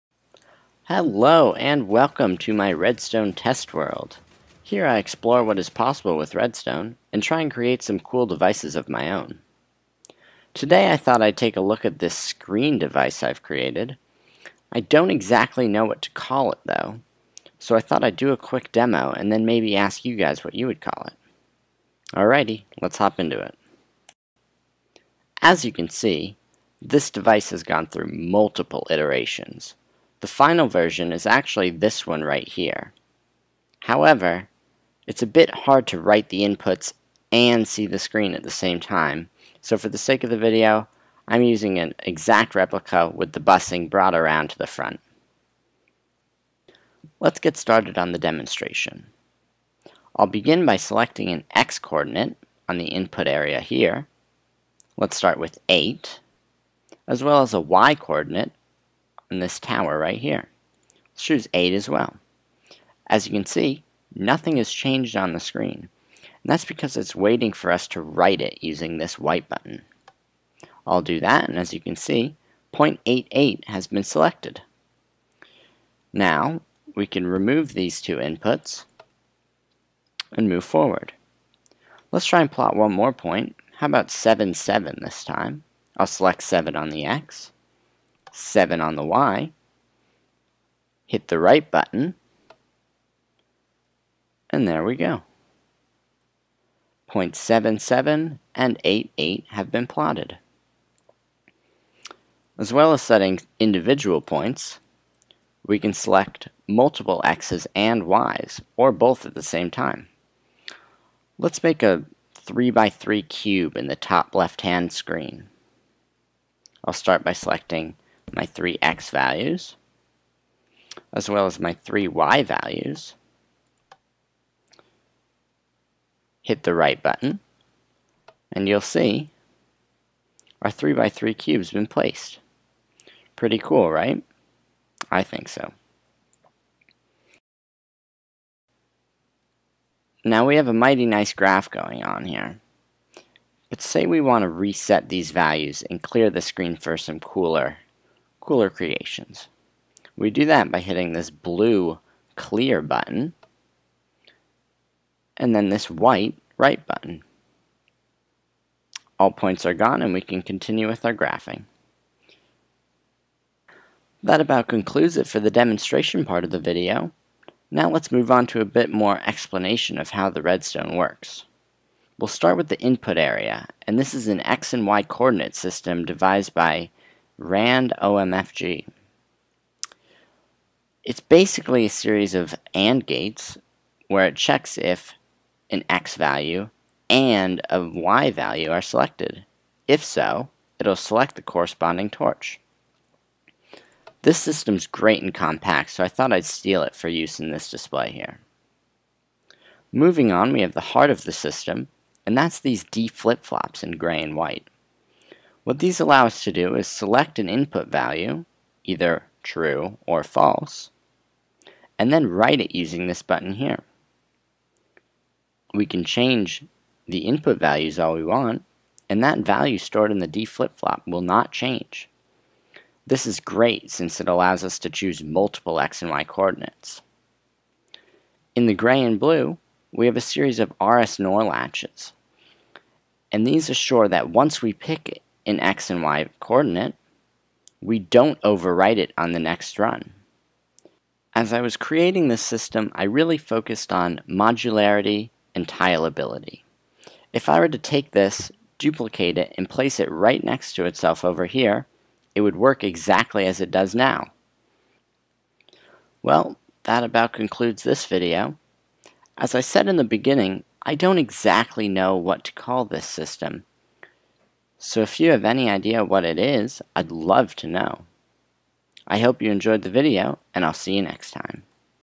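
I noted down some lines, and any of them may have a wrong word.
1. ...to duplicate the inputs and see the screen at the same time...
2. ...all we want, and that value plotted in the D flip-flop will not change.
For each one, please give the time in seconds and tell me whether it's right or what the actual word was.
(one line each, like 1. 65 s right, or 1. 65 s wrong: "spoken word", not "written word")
1. 35 s wrong: "write", not "duplicate"
2. 217 s wrong: "stored", not "plotted".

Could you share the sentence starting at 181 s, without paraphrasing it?
It's basically a series of AND gates where it checks if an X value and a Y value are selected.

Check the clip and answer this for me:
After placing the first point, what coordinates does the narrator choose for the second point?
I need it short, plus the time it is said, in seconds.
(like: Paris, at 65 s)
7, 7, at 83 s.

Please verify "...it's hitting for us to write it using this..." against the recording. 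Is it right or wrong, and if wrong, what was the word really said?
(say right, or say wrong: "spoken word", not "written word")
wrong: "waiting", not "hitting".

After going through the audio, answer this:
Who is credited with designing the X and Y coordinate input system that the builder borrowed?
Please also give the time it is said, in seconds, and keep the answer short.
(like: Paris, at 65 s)
Rand OMFG, at 177 s.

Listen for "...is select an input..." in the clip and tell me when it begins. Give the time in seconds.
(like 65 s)
206 s.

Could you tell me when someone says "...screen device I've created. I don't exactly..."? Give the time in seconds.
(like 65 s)
12 s.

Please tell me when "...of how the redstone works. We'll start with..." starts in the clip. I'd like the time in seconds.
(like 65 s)
169 s.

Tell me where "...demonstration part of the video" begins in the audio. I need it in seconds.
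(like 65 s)
165 s.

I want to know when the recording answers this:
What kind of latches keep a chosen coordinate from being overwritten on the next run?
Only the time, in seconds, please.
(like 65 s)
230 s.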